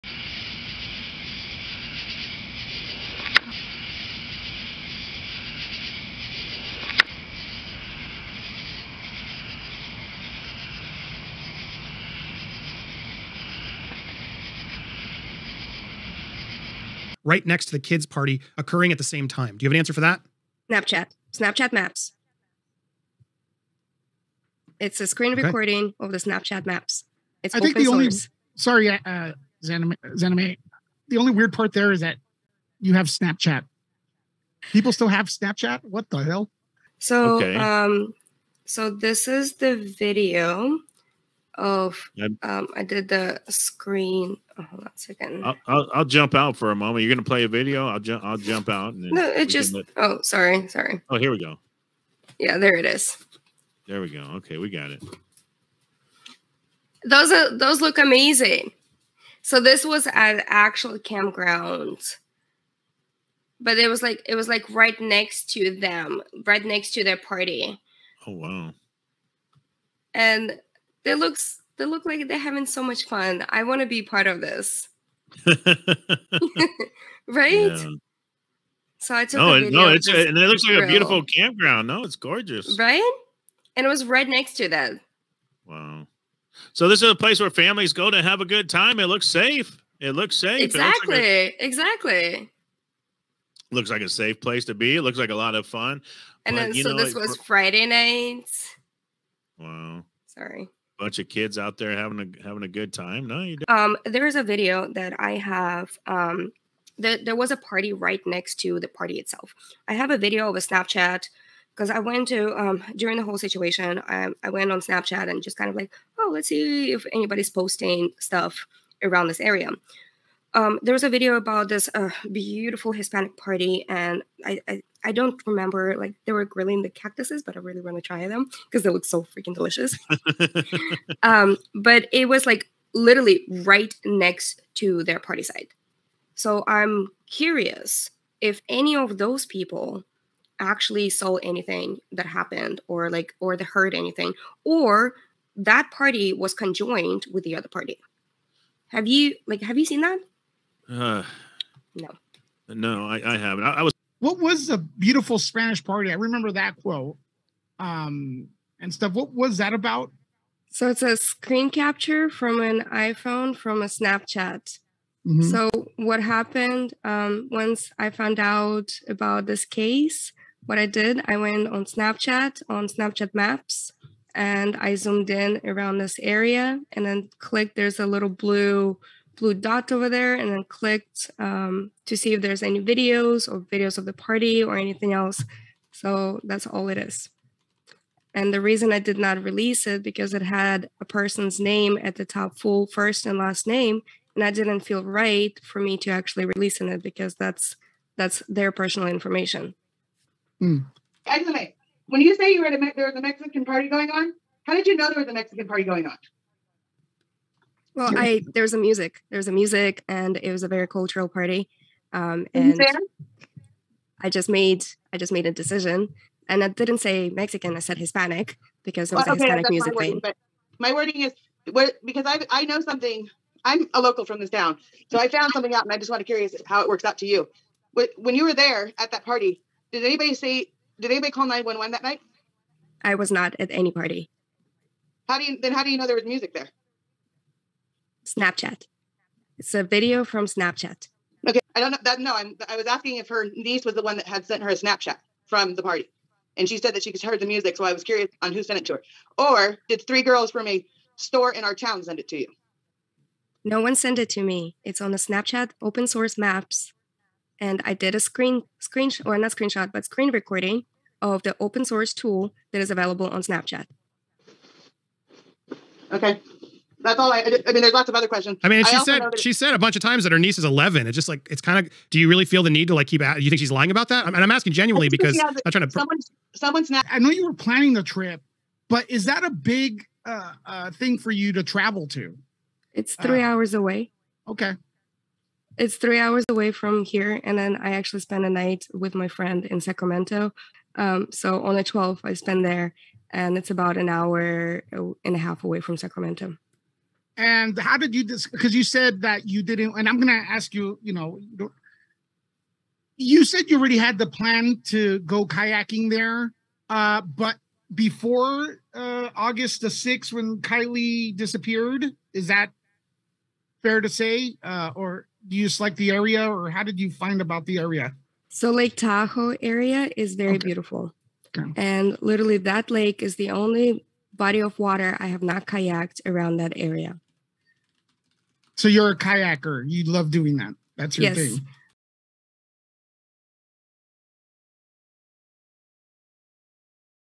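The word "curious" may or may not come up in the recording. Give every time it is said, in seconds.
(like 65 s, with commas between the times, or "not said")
137 s, 226 s, 248 s.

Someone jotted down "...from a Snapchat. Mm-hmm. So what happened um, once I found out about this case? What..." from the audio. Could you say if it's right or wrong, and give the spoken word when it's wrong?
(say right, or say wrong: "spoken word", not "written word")
right.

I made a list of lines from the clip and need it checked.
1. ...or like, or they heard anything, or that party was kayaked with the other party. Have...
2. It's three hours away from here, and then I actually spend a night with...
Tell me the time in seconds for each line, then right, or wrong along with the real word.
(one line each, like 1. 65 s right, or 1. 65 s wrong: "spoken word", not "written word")
1. 142 s wrong: "conjoined", not "kayaked"
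2. 285 s right.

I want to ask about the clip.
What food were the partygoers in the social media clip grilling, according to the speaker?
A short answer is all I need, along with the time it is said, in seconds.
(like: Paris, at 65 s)
cactuses, at 126 s.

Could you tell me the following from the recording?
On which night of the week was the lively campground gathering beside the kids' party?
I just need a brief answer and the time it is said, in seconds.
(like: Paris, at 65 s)
Friday night, at 97 s.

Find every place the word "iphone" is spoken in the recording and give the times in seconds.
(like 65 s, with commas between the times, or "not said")
162 s.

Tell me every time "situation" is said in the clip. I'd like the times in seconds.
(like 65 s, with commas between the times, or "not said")
113 s.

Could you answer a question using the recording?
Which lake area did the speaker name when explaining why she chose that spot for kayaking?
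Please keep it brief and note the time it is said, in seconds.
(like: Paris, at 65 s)
Lake Tahoe, at 318 s.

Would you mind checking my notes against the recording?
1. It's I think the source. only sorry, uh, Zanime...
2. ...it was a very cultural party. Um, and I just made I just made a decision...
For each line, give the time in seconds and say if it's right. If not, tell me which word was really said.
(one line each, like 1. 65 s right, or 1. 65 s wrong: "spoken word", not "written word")
1. 27 s right
2. 210 s right.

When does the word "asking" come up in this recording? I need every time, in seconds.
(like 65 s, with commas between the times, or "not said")
242 s, 274 s.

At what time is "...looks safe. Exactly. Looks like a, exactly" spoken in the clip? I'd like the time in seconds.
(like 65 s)
90 s.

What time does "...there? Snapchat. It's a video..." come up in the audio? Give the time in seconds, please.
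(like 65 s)
236 s.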